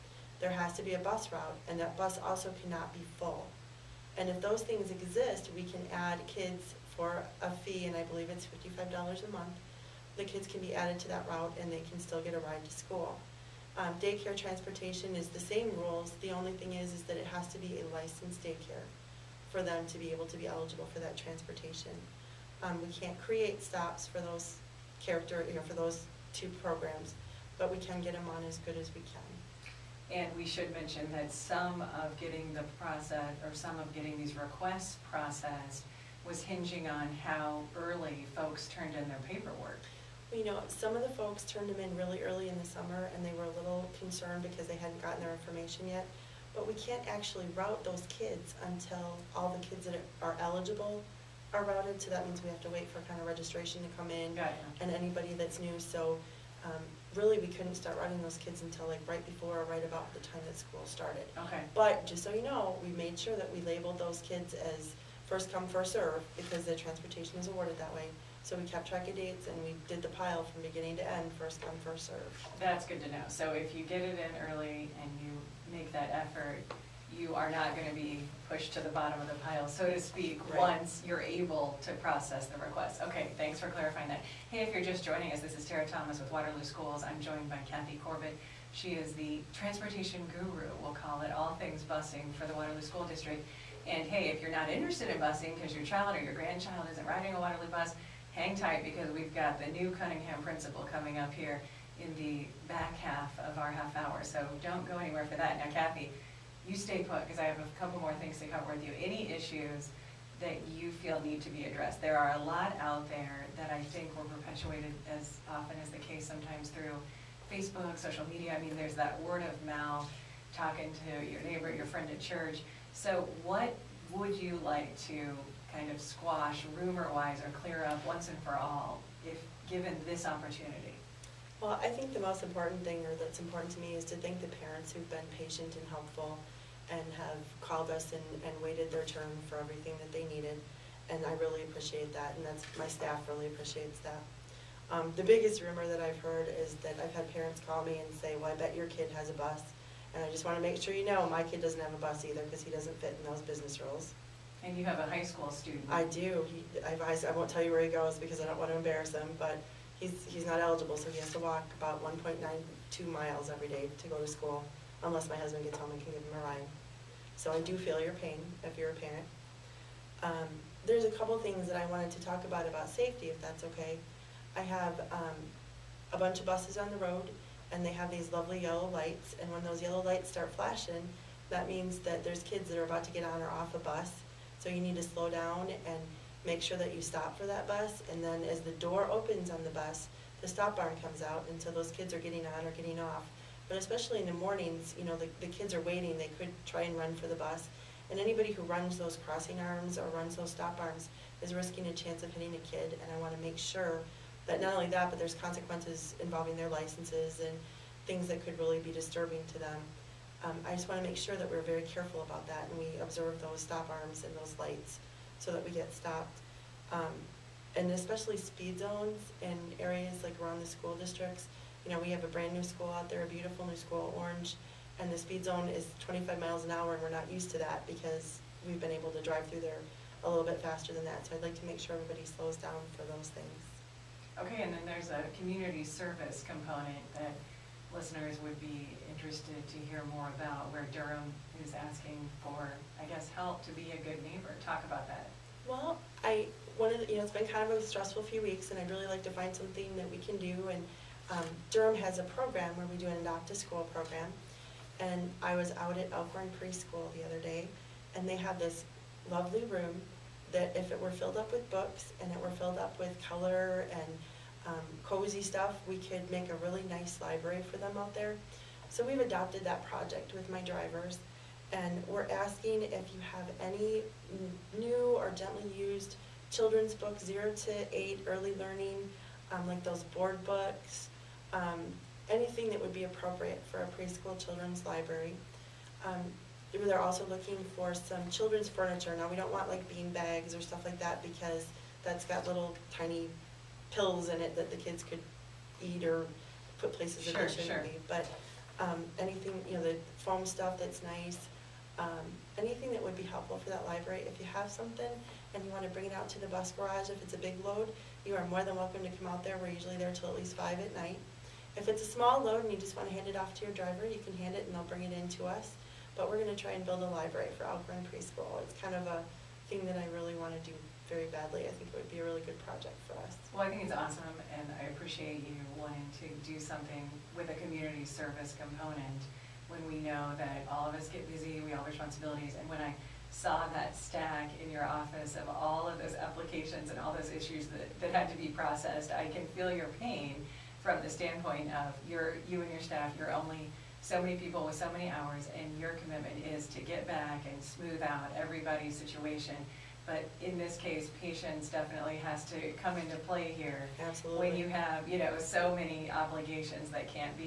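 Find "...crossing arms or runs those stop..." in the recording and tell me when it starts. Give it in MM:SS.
03:19.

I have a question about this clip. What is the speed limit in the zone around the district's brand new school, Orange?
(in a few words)
25 miles an hour.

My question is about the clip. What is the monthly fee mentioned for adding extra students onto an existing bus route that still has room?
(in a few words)
$55.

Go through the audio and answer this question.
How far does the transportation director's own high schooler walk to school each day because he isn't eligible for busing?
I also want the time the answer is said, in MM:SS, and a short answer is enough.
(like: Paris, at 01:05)
1.92 miles, at 02:42.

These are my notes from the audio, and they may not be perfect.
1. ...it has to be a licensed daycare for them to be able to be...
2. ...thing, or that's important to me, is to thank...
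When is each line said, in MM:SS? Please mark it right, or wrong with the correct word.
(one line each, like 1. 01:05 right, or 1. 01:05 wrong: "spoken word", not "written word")
1. 00:17 right
2. 02:12 right.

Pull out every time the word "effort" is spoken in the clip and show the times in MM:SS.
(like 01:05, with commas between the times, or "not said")
01:16.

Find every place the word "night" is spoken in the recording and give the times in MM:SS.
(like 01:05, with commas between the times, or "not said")
05:10.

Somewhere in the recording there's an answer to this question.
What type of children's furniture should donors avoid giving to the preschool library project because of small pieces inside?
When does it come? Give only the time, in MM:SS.
04:49.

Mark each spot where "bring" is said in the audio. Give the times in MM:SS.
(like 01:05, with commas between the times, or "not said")
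05:05, 05:14.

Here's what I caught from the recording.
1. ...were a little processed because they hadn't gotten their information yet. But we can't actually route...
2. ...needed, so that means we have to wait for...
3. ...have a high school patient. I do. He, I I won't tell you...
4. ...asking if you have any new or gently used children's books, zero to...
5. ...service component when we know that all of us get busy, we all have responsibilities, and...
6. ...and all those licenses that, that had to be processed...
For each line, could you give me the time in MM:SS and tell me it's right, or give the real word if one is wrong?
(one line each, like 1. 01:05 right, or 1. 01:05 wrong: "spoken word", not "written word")
1. 00:43 wrong: "concerned", not "processed"
2. 00:51 wrong: "routed", not "needed"
3. 02:34 wrong: "student", not "patient"
4. 04:32 right
5. 05:28 right
6. 05:36 wrong: "issues", not "licenses".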